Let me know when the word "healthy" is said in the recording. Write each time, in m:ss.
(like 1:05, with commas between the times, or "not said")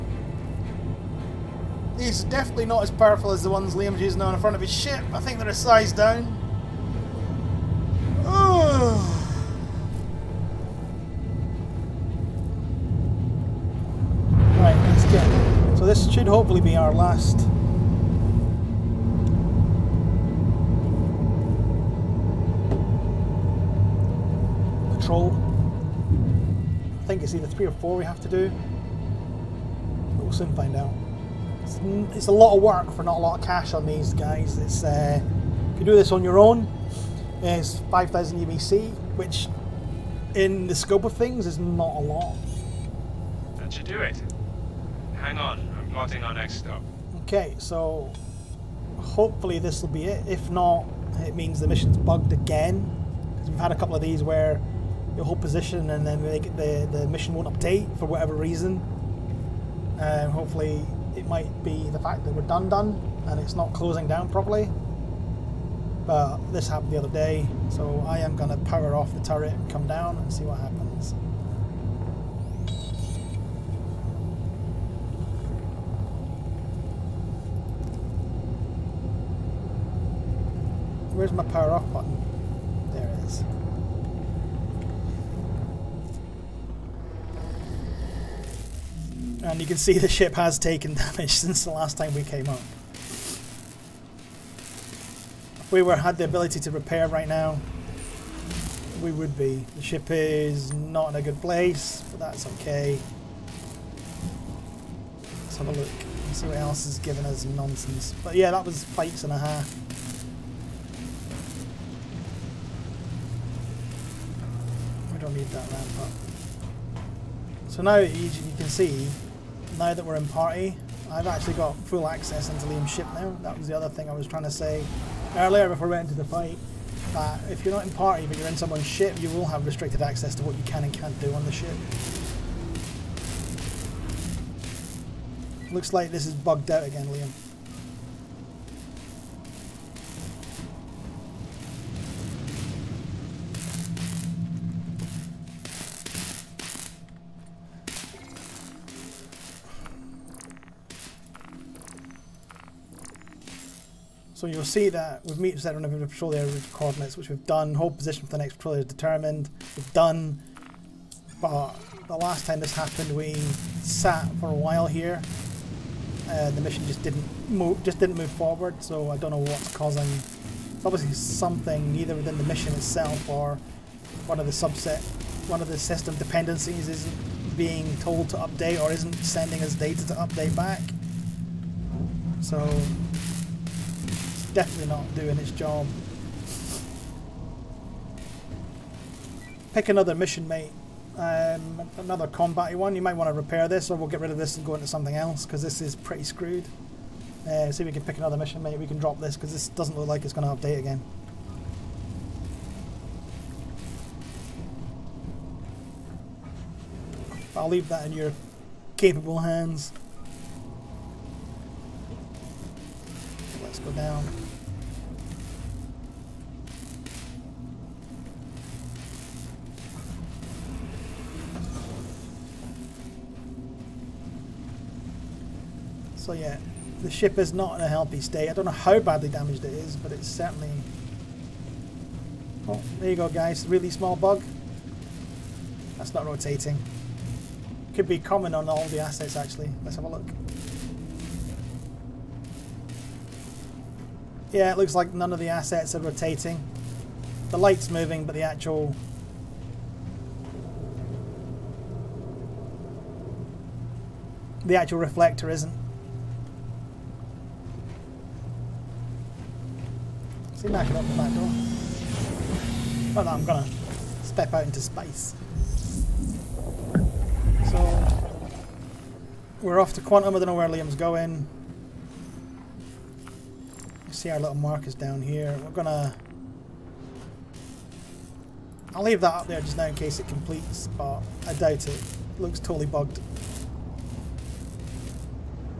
3:47.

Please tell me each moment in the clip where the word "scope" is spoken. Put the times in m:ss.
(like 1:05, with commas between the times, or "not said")
0:40.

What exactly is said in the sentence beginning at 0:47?
Okay, so hopefully this will be it.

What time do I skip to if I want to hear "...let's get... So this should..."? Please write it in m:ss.
0:14.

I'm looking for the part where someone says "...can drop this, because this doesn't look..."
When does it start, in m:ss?
3:18.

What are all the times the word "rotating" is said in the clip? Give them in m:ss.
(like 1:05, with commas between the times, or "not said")
3:56, 4:05.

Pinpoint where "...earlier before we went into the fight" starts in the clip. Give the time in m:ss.
2:05.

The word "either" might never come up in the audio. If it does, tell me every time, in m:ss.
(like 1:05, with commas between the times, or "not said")
0:27, 2:51.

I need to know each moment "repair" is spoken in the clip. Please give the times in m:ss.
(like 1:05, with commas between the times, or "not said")
1:36, 3:13.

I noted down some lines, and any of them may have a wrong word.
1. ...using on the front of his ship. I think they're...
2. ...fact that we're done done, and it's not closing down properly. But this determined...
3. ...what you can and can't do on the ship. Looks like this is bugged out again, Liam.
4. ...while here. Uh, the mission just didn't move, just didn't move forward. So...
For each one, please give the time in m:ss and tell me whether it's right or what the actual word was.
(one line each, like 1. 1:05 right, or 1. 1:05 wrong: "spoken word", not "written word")
1. 0:03 right
2. 1:01 wrong: "happened", not "determined"
3. 2:10 right
4. 2:44 right.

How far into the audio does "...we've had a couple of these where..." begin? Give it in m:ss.
0:53.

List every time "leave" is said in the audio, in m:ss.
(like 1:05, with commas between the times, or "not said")
3:27, 4:39.